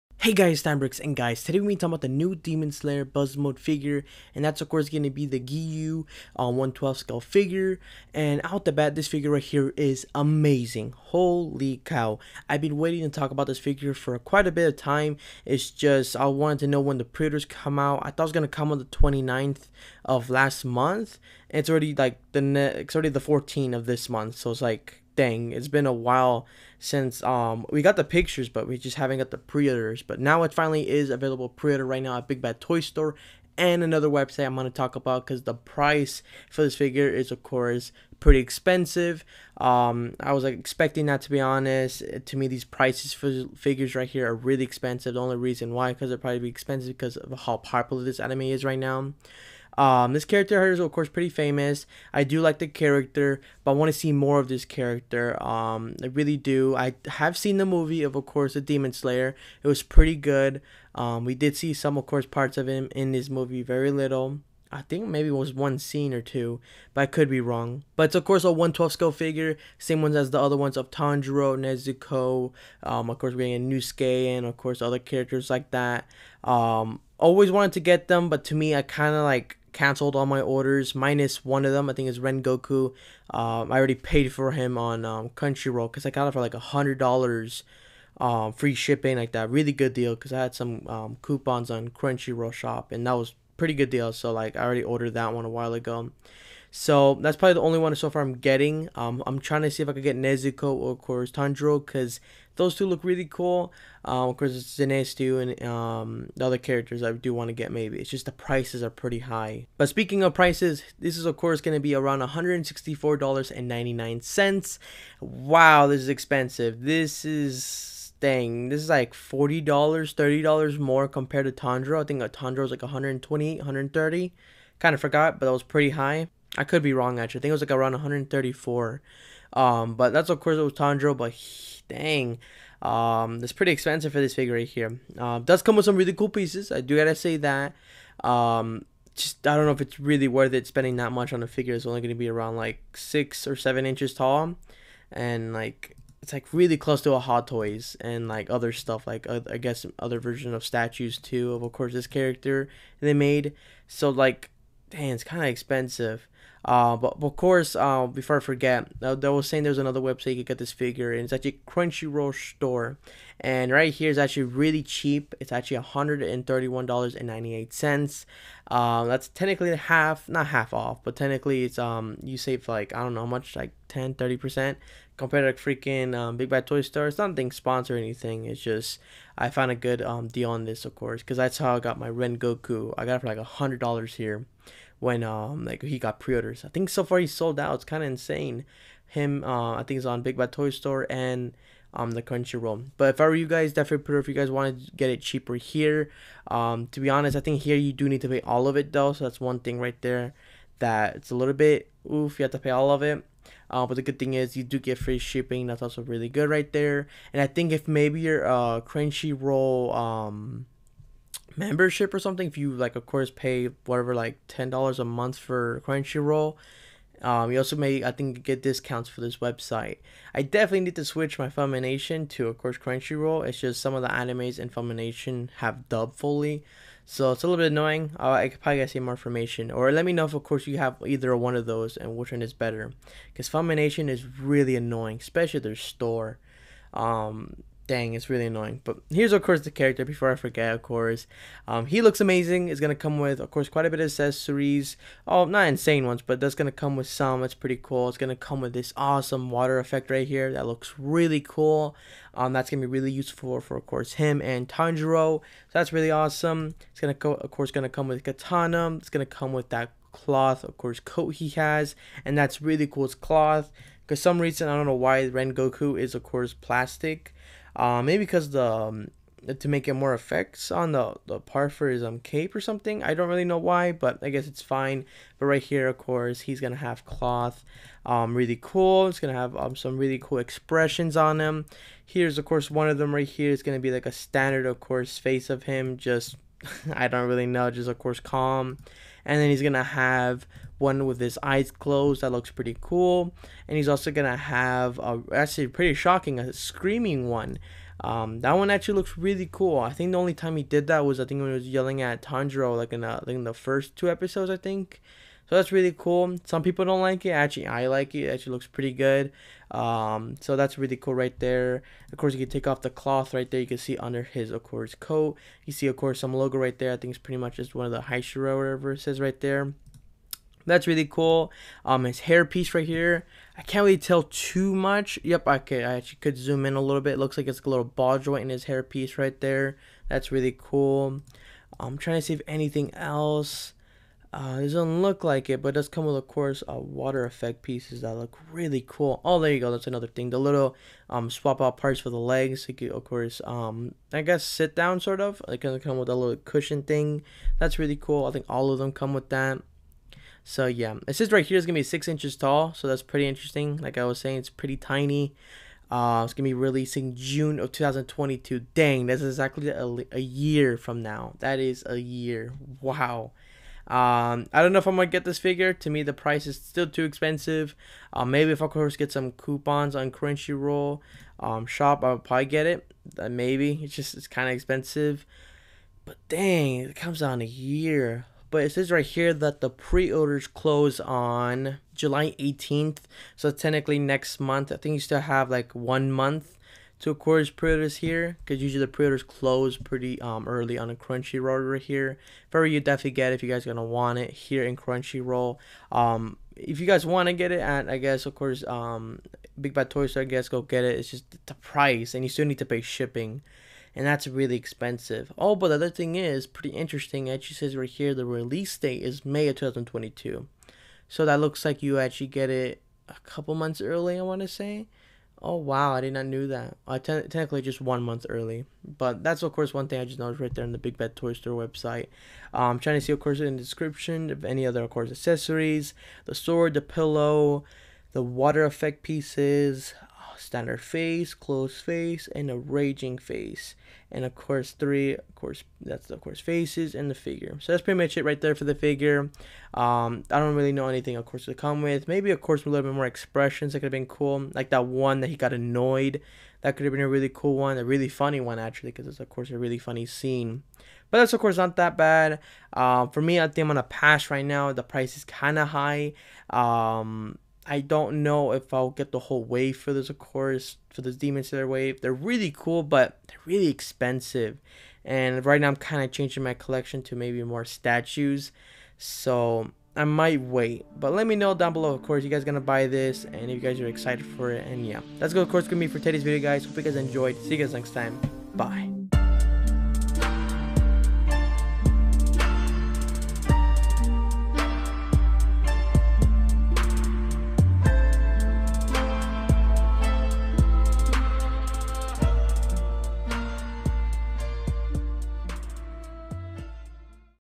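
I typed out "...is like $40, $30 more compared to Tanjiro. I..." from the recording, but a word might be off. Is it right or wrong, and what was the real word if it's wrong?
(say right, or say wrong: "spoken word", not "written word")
right.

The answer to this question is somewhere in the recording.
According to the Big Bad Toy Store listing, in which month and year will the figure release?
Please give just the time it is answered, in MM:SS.
06:49.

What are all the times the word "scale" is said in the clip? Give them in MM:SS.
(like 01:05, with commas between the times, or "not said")
00:06, 01:08.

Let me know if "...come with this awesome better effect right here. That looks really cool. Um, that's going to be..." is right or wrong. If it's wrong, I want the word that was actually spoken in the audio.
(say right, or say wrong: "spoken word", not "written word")
wrong: "water", not "better".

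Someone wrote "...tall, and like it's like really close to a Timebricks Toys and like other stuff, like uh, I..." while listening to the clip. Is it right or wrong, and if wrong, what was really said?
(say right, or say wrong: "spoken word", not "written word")
wrong: "Hot", not "Timebricks".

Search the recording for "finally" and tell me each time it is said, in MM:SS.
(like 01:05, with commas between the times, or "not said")
00:30.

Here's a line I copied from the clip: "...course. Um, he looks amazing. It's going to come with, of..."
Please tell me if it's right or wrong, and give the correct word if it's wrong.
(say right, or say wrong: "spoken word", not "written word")
right.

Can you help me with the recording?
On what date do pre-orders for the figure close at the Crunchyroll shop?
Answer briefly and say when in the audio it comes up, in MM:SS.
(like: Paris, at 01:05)
July 18th, at 06:21.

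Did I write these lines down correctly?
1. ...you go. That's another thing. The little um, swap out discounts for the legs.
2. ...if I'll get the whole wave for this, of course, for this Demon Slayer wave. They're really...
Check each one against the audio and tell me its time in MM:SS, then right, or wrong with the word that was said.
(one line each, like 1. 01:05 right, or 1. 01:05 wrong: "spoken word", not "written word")
1. 05:39 wrong: "parts", not "discounts"
2. 07:38 right.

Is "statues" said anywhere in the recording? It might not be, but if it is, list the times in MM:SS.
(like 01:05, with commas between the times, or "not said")
02:30, 07:47.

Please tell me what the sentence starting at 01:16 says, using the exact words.
Um, always wanted to get them, but to me I kind of like canceled all my orders minus one of them.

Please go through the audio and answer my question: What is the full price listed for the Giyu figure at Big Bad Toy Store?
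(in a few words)
$164.99.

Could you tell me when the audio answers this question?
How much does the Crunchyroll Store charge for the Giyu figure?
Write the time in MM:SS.
02:45.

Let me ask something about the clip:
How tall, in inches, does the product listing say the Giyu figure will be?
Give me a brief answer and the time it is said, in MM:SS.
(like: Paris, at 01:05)
6 inches, at 05:51.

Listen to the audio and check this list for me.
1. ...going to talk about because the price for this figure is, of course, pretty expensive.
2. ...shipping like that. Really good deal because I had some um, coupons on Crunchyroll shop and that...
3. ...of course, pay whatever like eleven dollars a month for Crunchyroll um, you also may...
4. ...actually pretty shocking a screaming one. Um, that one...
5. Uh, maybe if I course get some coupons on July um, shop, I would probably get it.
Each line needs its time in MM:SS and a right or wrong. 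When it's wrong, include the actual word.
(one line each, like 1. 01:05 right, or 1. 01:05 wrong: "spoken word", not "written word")
1. 00:34 right
2. 01:28 right
3. 03:32 wrong: "ten", not "eleven"
4. 04:55 right
5. 06:08 wrong: "Crunchyroll", not "July".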